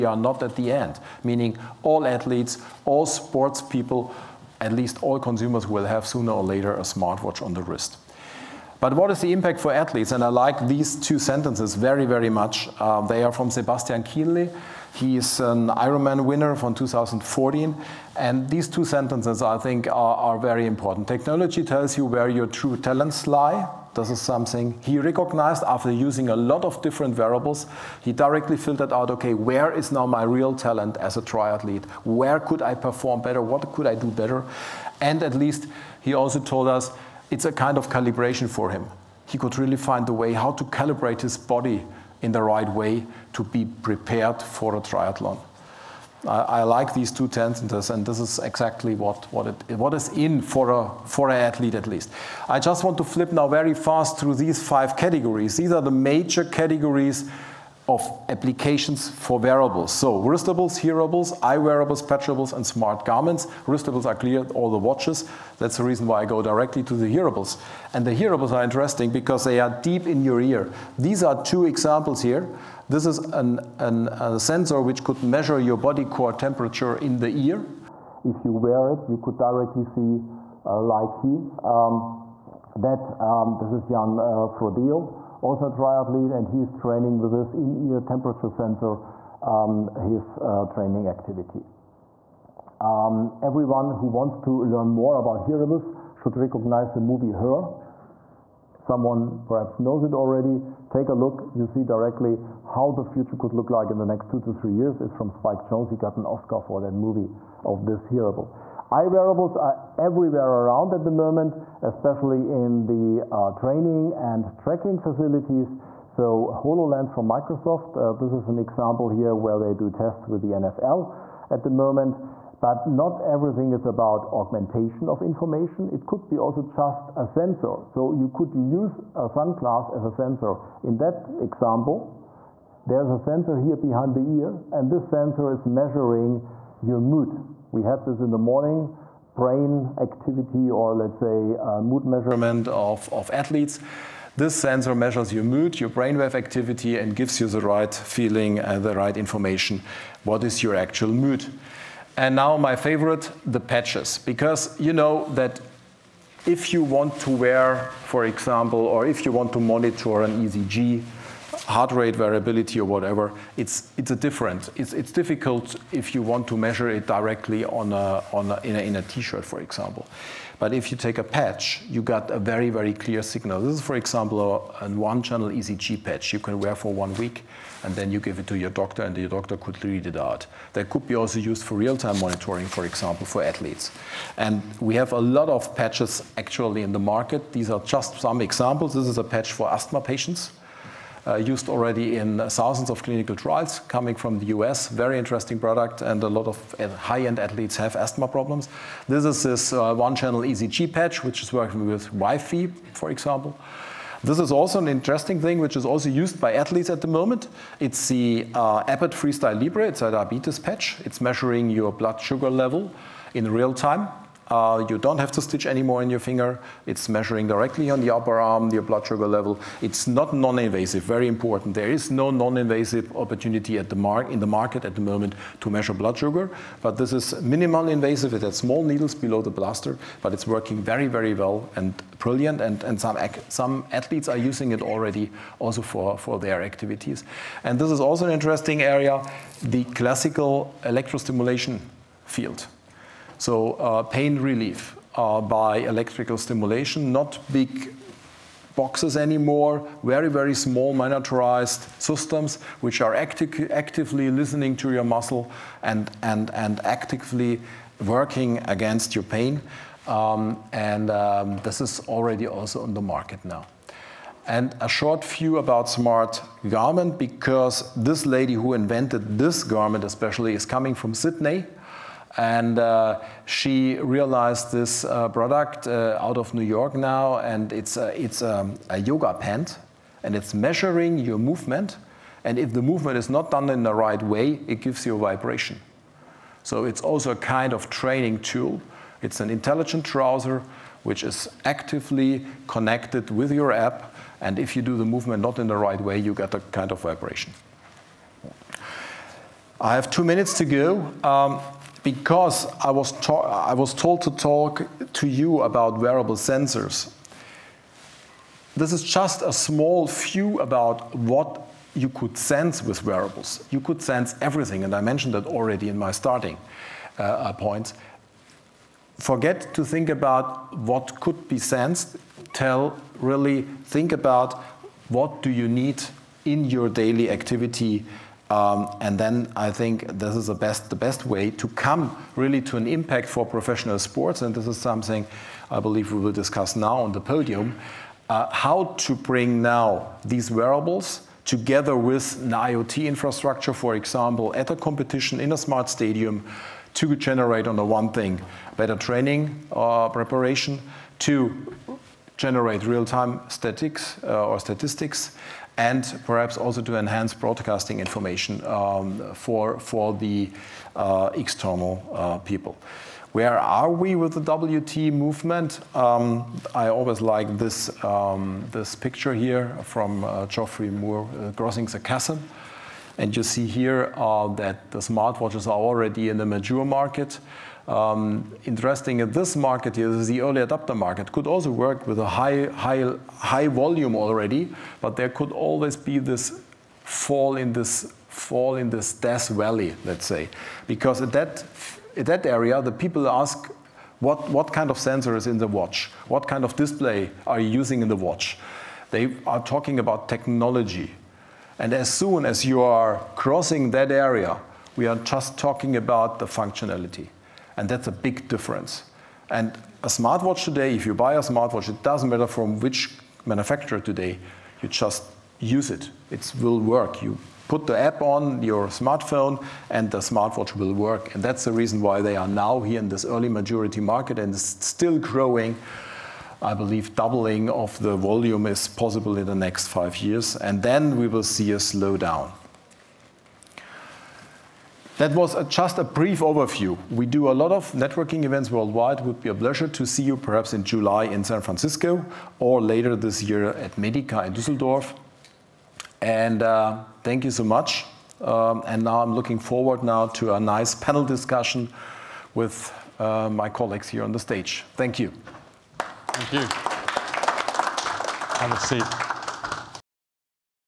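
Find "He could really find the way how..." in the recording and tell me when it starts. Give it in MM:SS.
00:39.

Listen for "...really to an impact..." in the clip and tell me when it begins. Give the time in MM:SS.
05:32.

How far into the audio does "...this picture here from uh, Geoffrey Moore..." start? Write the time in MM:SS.
06:08.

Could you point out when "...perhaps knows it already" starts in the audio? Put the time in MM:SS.
01:39.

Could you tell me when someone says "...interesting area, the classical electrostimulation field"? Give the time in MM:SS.
03:58.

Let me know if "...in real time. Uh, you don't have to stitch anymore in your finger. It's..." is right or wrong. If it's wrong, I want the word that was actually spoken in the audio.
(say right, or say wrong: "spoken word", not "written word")
right.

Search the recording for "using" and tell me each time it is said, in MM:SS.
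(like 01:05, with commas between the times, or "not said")
00:25, 03:54, 06:37.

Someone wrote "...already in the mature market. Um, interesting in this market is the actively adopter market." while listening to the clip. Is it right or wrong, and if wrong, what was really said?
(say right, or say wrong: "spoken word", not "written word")
wrong: "early", not "actively".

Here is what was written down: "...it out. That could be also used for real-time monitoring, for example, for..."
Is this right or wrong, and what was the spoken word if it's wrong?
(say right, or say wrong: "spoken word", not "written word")
right.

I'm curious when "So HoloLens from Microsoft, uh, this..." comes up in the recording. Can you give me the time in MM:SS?
01:56.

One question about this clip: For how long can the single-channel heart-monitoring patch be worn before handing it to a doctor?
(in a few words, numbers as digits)
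one week.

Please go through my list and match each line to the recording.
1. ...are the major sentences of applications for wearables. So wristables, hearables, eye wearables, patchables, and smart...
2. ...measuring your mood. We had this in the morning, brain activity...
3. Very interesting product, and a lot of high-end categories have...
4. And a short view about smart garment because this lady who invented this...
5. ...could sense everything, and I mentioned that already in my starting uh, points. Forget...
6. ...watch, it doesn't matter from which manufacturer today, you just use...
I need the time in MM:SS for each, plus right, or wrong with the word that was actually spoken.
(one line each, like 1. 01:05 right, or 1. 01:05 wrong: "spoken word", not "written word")
1. 00:55 wrong: "categories", not "sentences"
2. 02:15 right
3. 03:14 wrong: "athletes", not "categories"
4. 04:24 right
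5. 05:13 right
6. 06:51 wrong: "smartwatch", not "watch".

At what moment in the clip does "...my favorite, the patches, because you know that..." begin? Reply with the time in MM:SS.
02:32.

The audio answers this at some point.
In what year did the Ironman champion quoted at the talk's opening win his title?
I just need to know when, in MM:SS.
00:16.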